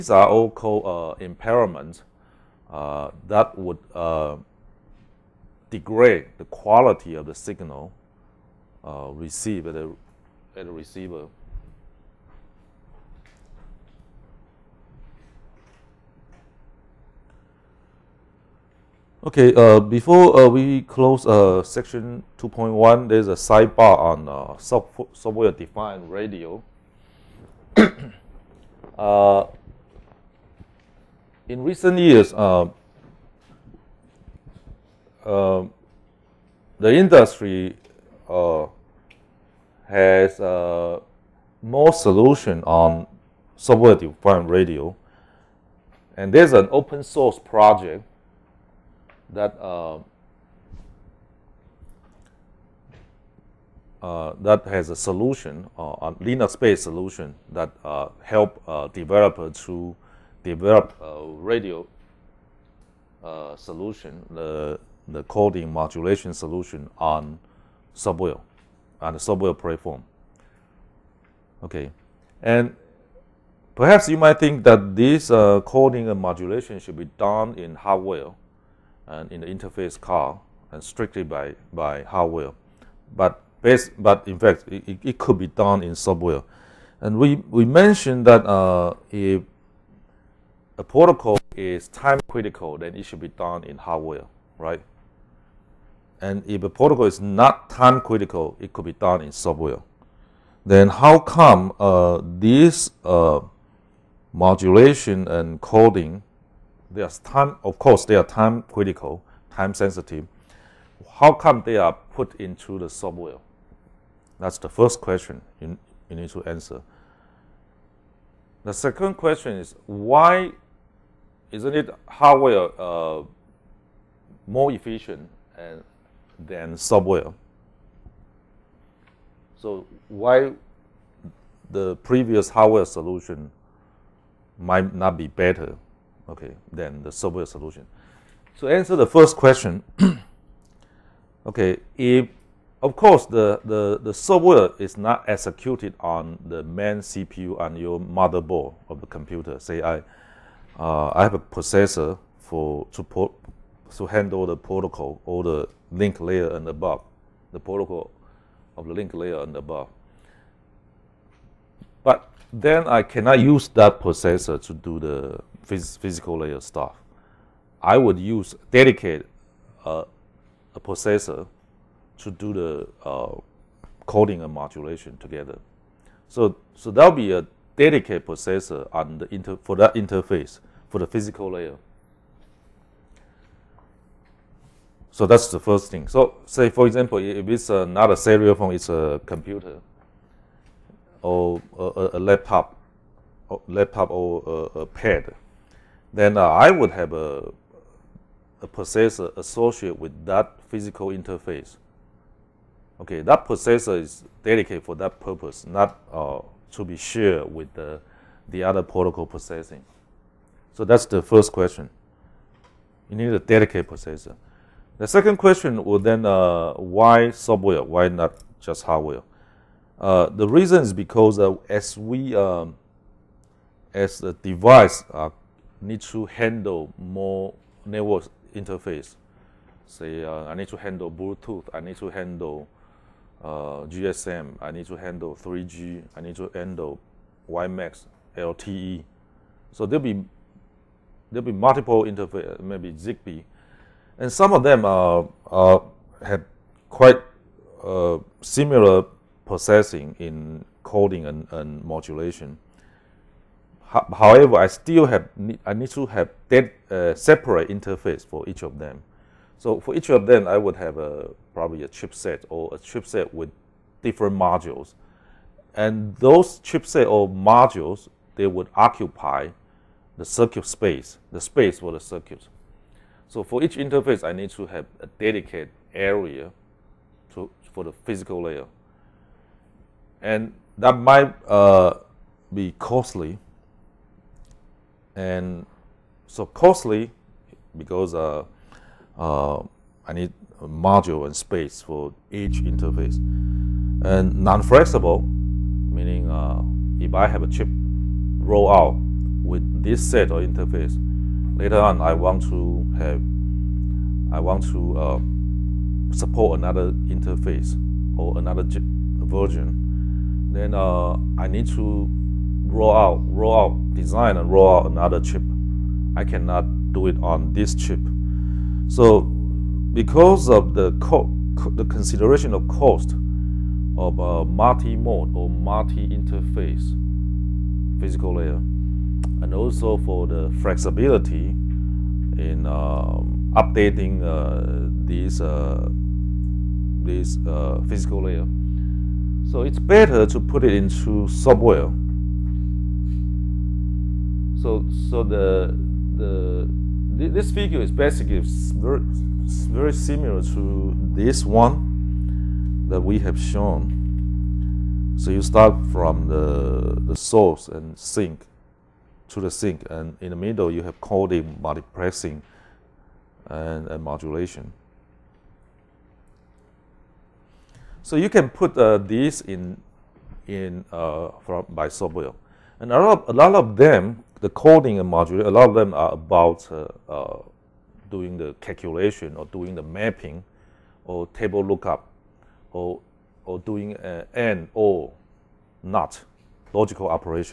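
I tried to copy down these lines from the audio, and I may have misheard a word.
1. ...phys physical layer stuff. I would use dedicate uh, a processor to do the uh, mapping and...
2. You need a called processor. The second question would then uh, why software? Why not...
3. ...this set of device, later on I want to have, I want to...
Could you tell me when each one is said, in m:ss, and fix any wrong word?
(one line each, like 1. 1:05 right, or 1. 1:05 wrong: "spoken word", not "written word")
1. 2:45 wrong: "coding", not "mapping"
2. 3:33 wrong: "dedicated", not "called"
3. 4:59 wrong: "interface", not "device".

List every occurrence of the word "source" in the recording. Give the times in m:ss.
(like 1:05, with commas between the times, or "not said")
0:47, 5:57.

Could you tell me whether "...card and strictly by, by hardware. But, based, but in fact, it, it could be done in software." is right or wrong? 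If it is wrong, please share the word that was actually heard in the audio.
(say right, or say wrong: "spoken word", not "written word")
right.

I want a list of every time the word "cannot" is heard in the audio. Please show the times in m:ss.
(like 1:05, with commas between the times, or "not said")
2:43, 5:16.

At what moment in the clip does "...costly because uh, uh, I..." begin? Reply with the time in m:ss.
4:46.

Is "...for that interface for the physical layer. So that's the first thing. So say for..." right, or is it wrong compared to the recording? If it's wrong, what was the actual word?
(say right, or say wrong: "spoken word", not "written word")
right.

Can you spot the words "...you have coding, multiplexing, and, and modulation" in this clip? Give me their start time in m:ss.
6:00.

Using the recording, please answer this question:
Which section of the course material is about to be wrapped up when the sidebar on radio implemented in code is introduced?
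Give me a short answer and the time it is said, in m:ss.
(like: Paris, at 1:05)
2.1, at 0:22.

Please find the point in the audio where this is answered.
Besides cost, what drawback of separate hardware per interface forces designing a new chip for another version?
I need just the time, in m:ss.
4:54.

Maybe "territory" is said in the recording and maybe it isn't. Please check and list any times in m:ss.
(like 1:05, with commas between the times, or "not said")
not said.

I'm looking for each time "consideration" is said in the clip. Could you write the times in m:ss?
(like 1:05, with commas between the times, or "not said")
5:21.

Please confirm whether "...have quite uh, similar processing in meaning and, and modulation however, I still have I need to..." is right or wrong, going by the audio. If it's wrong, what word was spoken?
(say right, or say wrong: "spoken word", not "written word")
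wrong: "coding", not "meaning".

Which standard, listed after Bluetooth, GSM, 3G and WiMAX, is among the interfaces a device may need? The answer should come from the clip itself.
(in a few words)
LTE.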